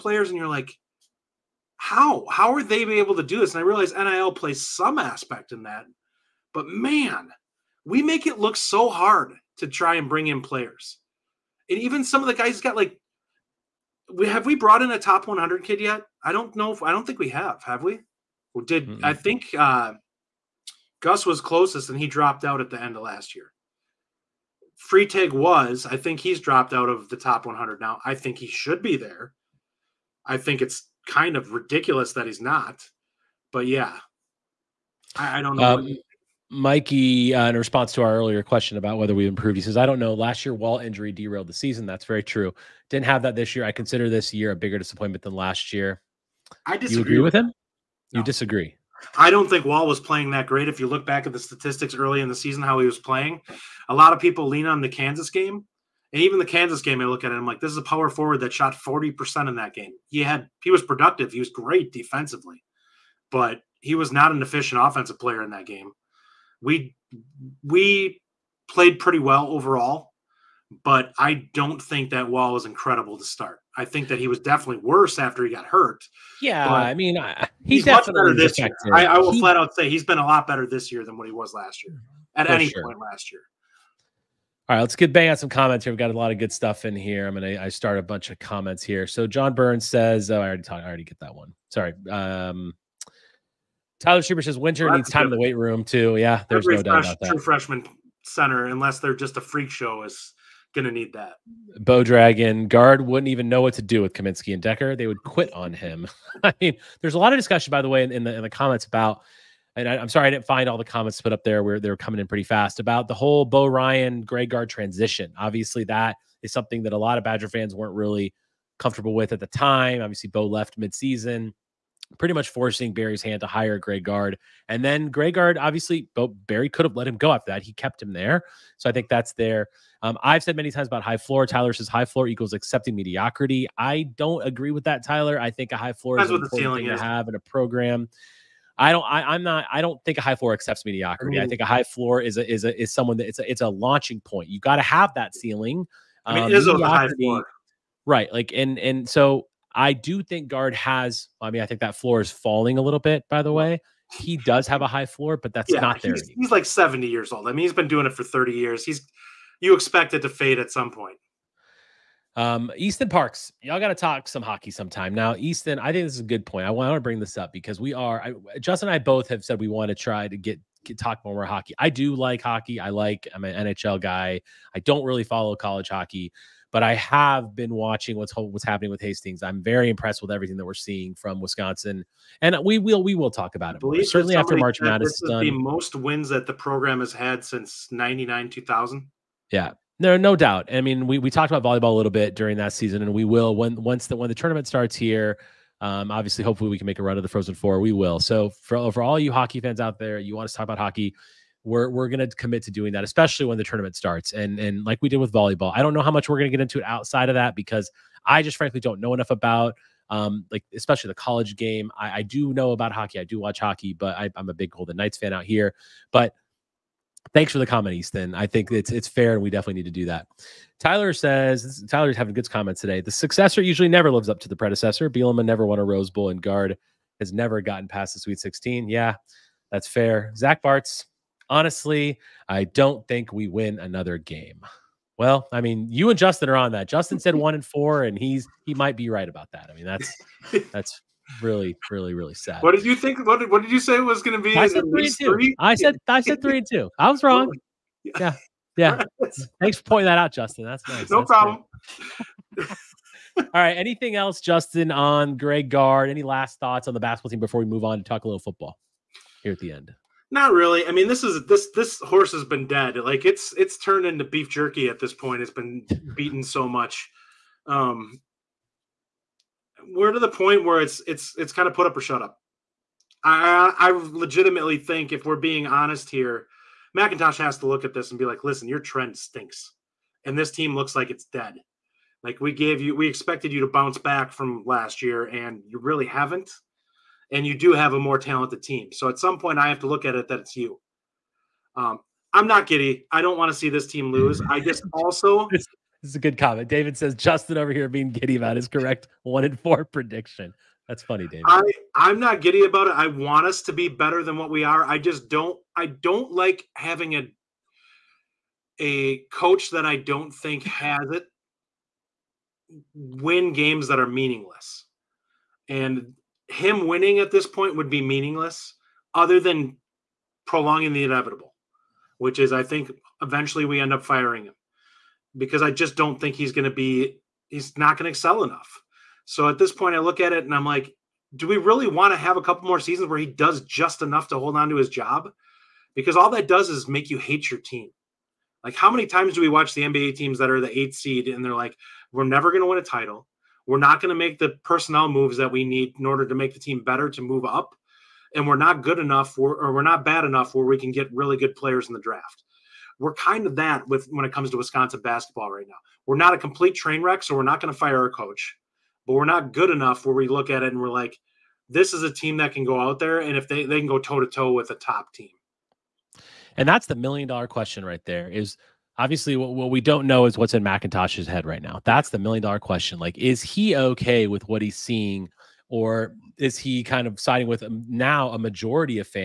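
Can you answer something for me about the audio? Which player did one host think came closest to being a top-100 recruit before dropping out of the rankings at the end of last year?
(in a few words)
Gus.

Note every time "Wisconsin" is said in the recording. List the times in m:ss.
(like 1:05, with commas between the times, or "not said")
3:01, 5:54.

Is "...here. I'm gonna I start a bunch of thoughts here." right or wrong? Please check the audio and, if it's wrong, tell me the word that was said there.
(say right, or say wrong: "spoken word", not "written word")
wrong: "comments", not "thoughts".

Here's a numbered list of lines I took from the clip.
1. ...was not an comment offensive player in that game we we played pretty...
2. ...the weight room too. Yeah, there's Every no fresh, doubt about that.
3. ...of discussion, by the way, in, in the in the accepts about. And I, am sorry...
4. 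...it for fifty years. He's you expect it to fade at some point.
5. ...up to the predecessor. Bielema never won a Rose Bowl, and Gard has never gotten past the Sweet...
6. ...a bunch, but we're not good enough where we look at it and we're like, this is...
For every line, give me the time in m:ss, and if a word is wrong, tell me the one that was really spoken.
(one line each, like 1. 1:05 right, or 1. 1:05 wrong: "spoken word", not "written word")
1. 1:03 wrong: "efficient", not "comment"
2. 1:35 right
3. 1:47 wrong: "comments", not "accepts"
4. 2:38 wrong: "thirty", not "fifty"
5. 3:44 right
6. 5:58 wrong: "coach", not "bunch".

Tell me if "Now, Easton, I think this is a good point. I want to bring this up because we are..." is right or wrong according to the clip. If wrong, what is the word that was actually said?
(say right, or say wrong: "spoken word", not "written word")
right.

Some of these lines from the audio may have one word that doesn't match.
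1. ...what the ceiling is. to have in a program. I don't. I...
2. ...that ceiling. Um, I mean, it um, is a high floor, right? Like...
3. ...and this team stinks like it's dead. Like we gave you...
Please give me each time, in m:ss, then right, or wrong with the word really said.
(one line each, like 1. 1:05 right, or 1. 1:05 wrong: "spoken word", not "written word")
1. 2:16 right
2. 2:25 right
3. 4:40 wrong: "looks", not "stinks".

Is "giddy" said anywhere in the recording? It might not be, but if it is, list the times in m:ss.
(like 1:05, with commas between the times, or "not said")
4:52, 4:58, 5:02.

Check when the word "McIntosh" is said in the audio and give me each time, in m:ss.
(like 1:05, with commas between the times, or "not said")
4:36, 6:10.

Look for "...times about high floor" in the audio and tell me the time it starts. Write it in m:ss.
2:10.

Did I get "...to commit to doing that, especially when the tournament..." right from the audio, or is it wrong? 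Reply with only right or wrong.
right.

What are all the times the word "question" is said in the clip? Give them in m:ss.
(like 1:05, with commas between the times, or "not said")
0:38, 6:07, 6:12.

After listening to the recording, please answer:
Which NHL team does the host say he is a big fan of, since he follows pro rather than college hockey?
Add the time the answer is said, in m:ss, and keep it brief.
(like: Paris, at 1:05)
Golden Knights, at 3:34.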